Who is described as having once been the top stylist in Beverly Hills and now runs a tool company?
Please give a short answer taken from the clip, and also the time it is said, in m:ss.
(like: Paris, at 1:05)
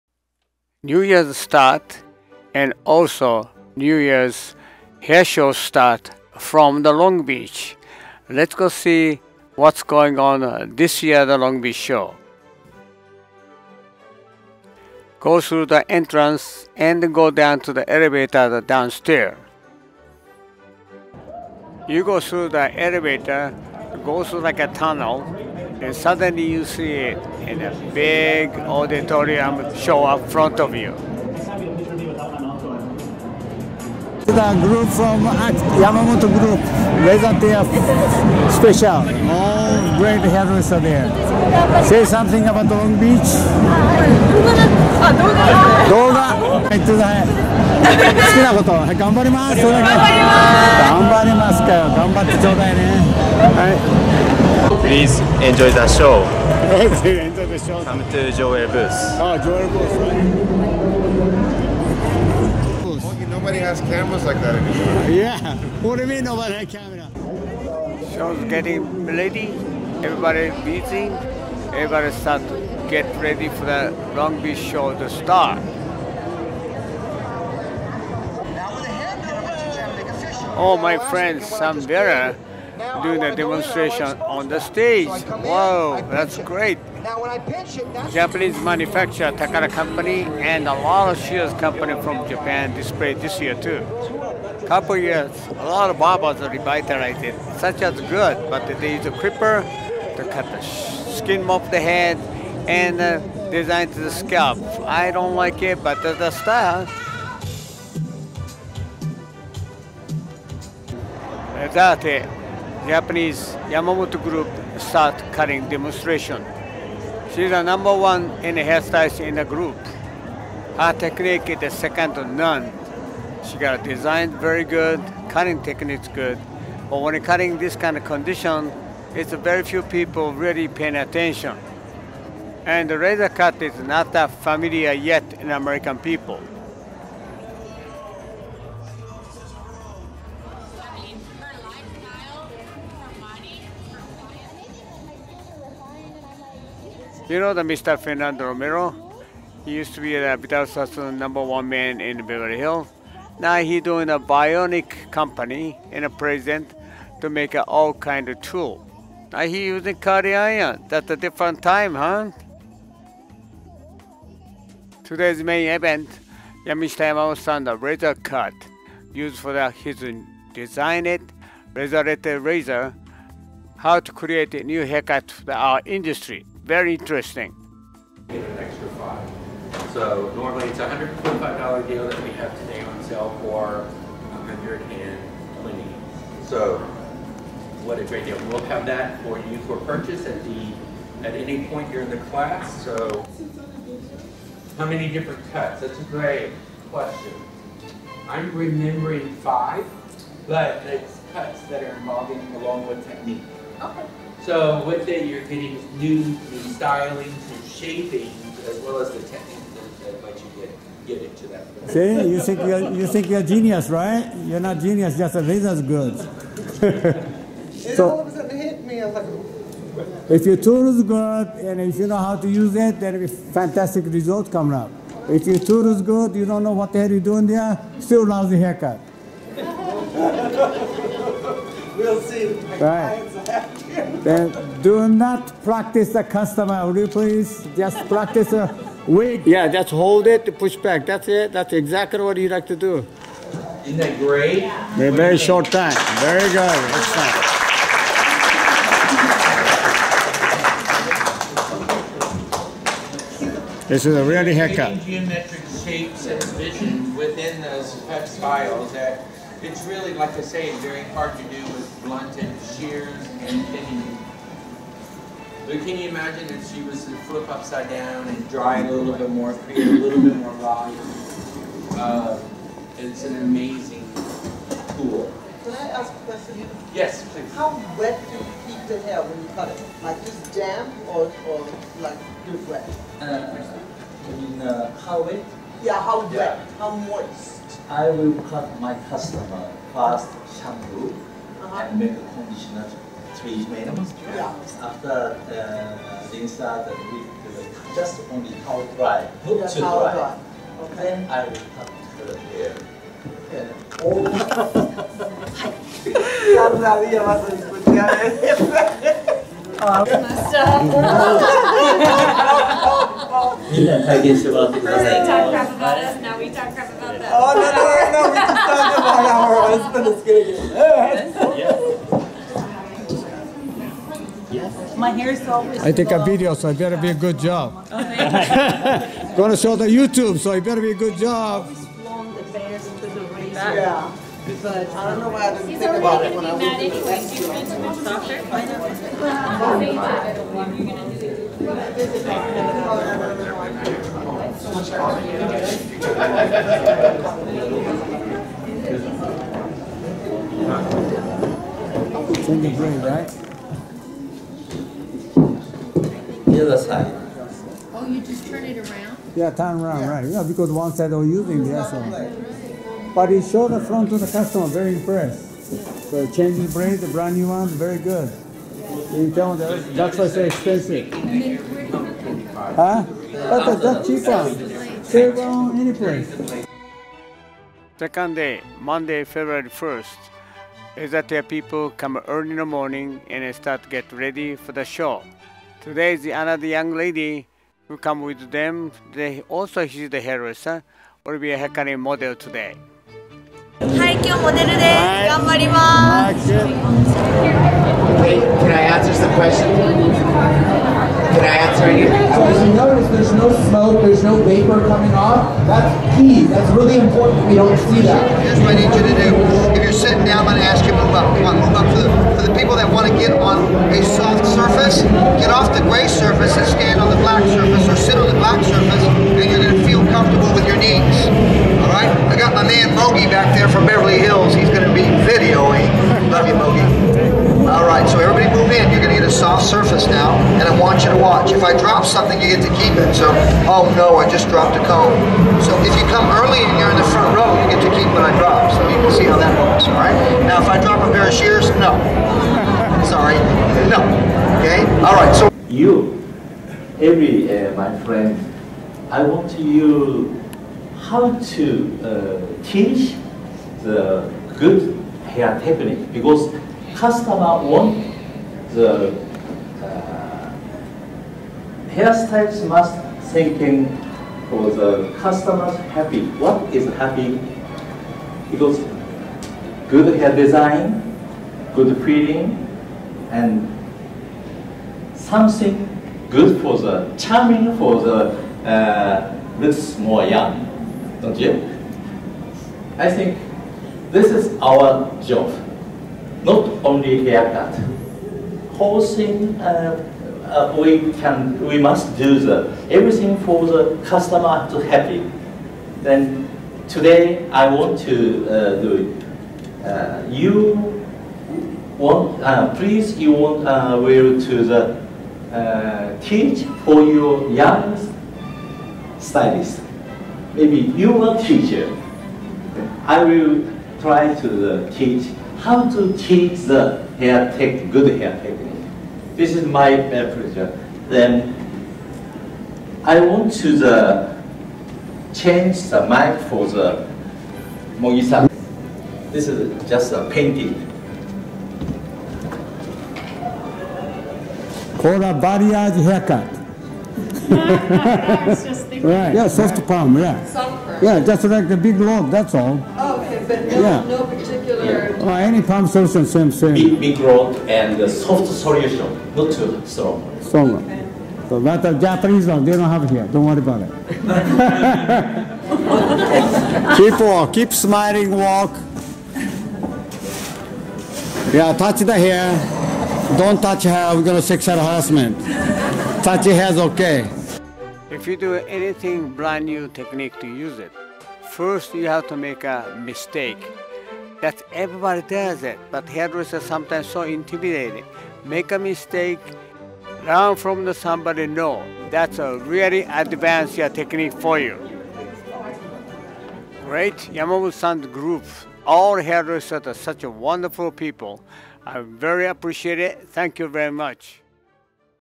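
Fernando Romero, at 2:27.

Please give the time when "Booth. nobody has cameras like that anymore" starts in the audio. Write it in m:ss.
1:02.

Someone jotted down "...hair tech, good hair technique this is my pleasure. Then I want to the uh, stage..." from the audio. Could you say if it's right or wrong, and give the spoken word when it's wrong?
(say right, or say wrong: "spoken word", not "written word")
wrong: "change", not "stage".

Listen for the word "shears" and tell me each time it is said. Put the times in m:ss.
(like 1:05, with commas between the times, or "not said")
1:31, 4:22, 7:21.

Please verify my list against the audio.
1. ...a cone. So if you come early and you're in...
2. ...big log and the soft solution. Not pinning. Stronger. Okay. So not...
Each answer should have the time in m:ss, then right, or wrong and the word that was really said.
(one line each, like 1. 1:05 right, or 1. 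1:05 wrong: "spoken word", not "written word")
1. 7:14 right
2. 9:07 wrong: "strong", not "pinning".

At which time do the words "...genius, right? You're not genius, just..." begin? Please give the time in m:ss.
3:33.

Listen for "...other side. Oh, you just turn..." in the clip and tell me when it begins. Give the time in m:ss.
5:56.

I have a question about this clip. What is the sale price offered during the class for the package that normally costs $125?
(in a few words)
$120.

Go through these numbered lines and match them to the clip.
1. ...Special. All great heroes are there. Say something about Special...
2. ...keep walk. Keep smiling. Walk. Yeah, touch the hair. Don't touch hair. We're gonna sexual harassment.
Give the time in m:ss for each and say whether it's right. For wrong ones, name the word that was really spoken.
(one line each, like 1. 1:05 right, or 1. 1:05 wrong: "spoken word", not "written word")
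1. 0:38 wrong: "Long", not "Special"
2. 9:16 right.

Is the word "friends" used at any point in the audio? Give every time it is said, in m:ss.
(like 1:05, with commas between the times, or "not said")
1:20, 7:28.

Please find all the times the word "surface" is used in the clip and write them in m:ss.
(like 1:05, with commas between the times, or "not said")
7:09.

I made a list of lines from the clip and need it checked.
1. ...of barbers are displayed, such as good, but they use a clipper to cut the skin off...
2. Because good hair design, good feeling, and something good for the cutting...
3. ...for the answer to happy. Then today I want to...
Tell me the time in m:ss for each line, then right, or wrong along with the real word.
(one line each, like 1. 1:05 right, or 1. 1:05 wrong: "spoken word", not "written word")
1. 1:35 wrong: "revitalized", not "displayed"
2. 7:48 wrong: "charming", not "cutting"
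3. 8:13 wrong: "customer", not "answer".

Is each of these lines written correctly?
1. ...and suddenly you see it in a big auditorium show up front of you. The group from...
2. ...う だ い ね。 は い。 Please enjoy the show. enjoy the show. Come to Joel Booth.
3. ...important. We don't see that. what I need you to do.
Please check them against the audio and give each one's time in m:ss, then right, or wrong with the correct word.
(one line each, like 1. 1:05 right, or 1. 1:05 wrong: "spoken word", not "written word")
1. 0:25 right
2. 0:52 right
3. 6:46 right.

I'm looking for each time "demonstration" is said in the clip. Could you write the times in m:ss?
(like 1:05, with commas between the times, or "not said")
1:23, 1:55.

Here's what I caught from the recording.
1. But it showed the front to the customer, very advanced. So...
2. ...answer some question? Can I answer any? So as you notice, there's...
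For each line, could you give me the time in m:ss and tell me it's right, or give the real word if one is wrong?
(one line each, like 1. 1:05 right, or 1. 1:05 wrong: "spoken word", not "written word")
1. 6:03 wrong: "impressed", not "advanced"
2. 6:38 right.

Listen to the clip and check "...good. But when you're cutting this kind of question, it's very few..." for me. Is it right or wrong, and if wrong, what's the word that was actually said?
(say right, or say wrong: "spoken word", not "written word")
wrong: "condition", not "question".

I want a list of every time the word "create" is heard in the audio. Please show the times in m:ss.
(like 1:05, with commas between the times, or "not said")
2:54, 4:29.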